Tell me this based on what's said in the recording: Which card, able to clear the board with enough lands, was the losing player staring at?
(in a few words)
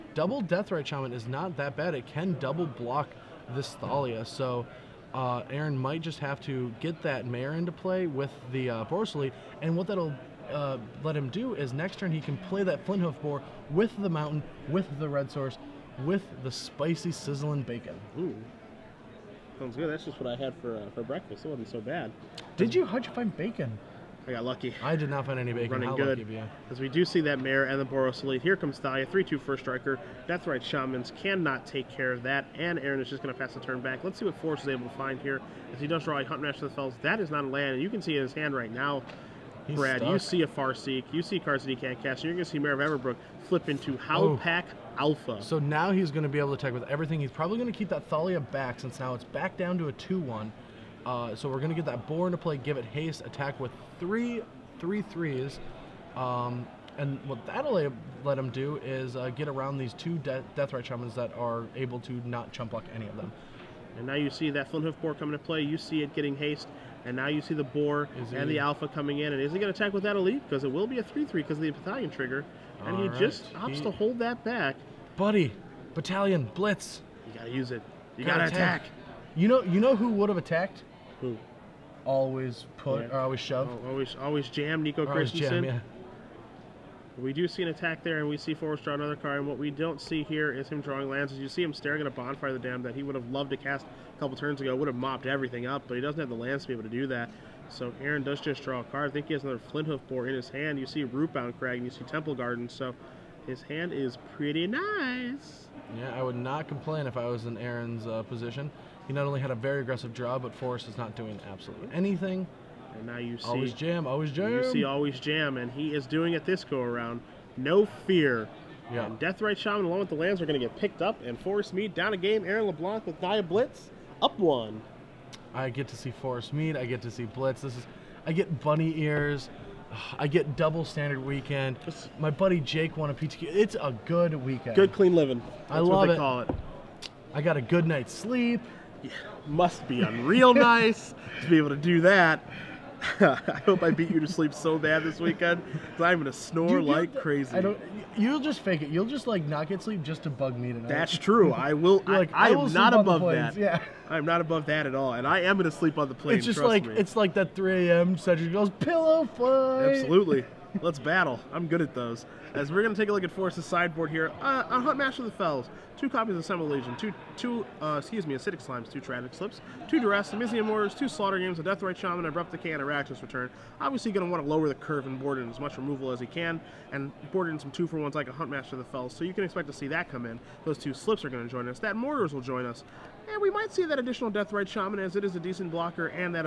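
Bonfire of the Damned.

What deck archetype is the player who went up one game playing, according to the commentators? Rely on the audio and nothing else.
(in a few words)
Naya Blitz.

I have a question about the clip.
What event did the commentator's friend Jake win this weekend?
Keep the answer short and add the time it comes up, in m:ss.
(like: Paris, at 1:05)
A PTQ, at 2:13.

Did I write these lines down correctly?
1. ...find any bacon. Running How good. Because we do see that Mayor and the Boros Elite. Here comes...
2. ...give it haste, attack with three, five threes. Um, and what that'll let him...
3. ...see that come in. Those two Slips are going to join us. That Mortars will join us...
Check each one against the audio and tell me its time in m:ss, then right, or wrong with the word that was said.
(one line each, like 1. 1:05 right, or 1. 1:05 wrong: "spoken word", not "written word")
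1. 0:25 right
2. 0:52 wrong: "three", not "five"
3. 2:59 right.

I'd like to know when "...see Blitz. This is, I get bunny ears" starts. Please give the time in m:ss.
2:07.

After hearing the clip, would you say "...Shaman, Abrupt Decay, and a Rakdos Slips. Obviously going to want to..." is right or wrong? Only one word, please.
wrong.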